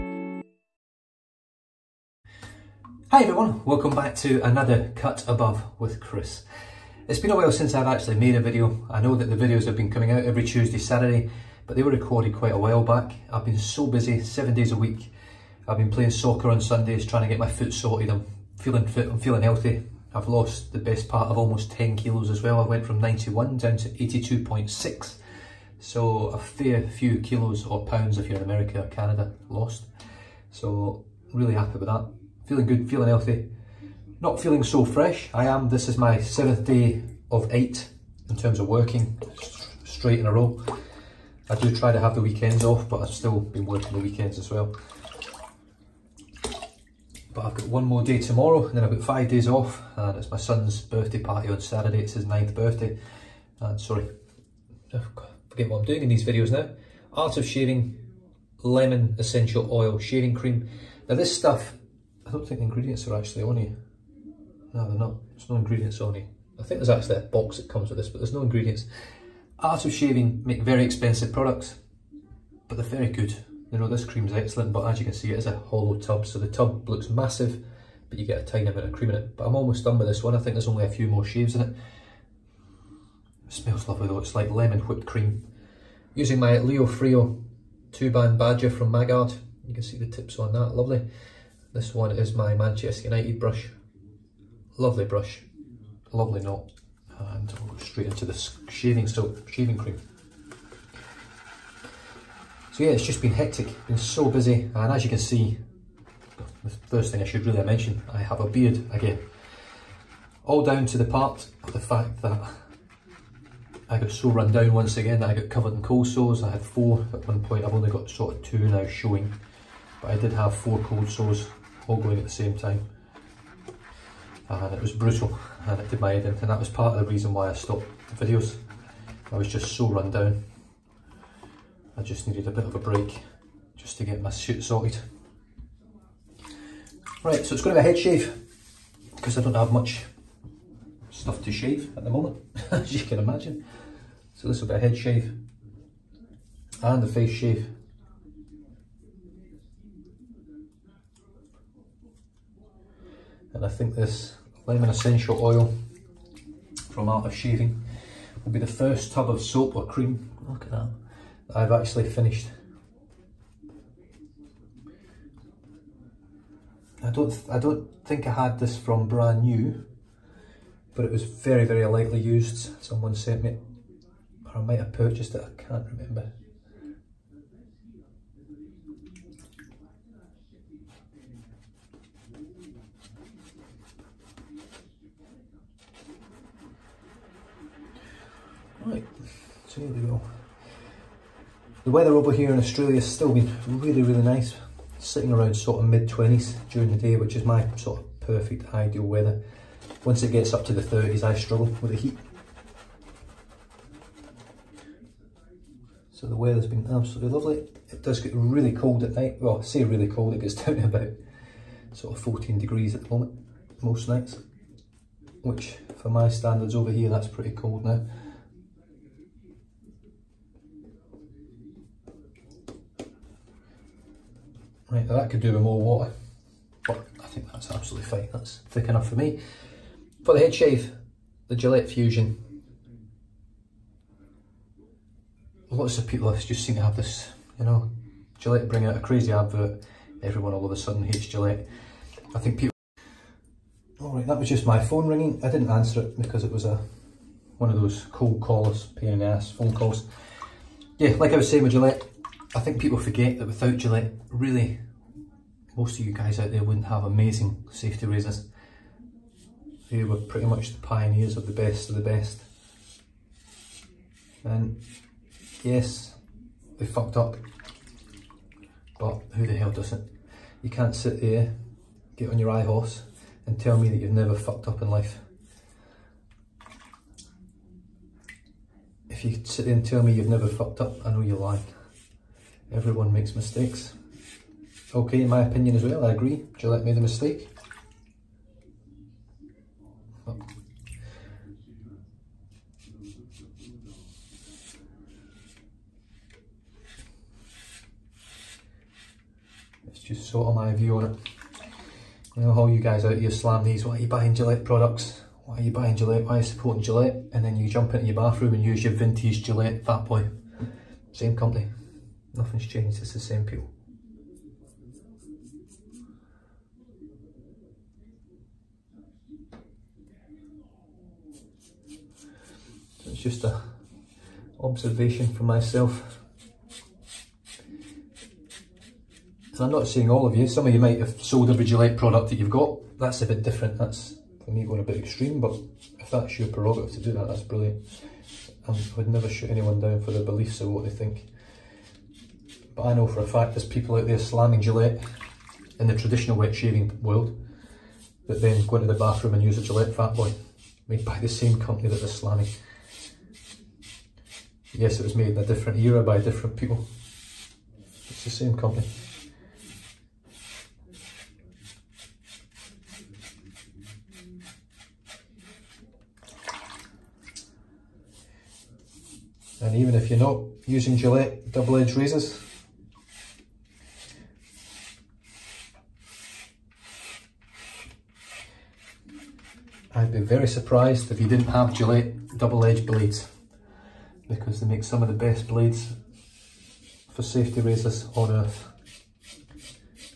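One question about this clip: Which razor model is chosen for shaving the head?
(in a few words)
Gillette Fusion.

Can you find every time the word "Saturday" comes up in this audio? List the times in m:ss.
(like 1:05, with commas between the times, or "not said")
0:10, 0:51.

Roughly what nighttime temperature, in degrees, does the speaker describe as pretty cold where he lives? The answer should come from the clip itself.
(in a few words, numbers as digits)
14.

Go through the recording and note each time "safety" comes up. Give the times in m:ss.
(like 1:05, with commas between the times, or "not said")
4:17, 6:27.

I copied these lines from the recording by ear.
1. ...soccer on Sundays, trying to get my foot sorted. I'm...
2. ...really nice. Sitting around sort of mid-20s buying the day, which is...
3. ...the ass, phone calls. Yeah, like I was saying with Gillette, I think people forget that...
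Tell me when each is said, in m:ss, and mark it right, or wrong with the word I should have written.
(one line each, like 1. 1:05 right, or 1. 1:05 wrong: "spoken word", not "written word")
1. 0:16 right
2. 3:14 wrong: "during", not "buying"
3. 4:09 right.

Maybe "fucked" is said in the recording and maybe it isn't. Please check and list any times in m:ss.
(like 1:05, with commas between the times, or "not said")
4:26, 4:34, 4:40.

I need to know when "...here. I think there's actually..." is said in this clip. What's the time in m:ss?
1:06.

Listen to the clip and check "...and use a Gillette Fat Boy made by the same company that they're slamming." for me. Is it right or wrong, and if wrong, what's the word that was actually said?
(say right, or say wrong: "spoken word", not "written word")
right.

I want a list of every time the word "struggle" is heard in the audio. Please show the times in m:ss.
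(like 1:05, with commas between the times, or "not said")
3:21.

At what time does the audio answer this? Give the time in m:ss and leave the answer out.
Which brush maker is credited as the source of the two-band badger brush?
1:28.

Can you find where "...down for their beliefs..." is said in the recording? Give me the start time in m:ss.
5:39.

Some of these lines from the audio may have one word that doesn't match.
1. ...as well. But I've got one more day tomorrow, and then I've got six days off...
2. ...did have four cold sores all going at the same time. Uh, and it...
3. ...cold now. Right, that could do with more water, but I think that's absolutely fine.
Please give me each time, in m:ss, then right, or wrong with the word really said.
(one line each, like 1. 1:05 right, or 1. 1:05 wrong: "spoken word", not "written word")
1. 0:44 wrong: "five", not "six"
2. 2:00 right
3. 3:37 right.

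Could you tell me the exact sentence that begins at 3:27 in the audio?
It does get really cold at night.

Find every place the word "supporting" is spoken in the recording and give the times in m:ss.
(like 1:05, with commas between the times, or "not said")
5:06.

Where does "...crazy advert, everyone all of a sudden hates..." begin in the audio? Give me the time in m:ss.
3:58.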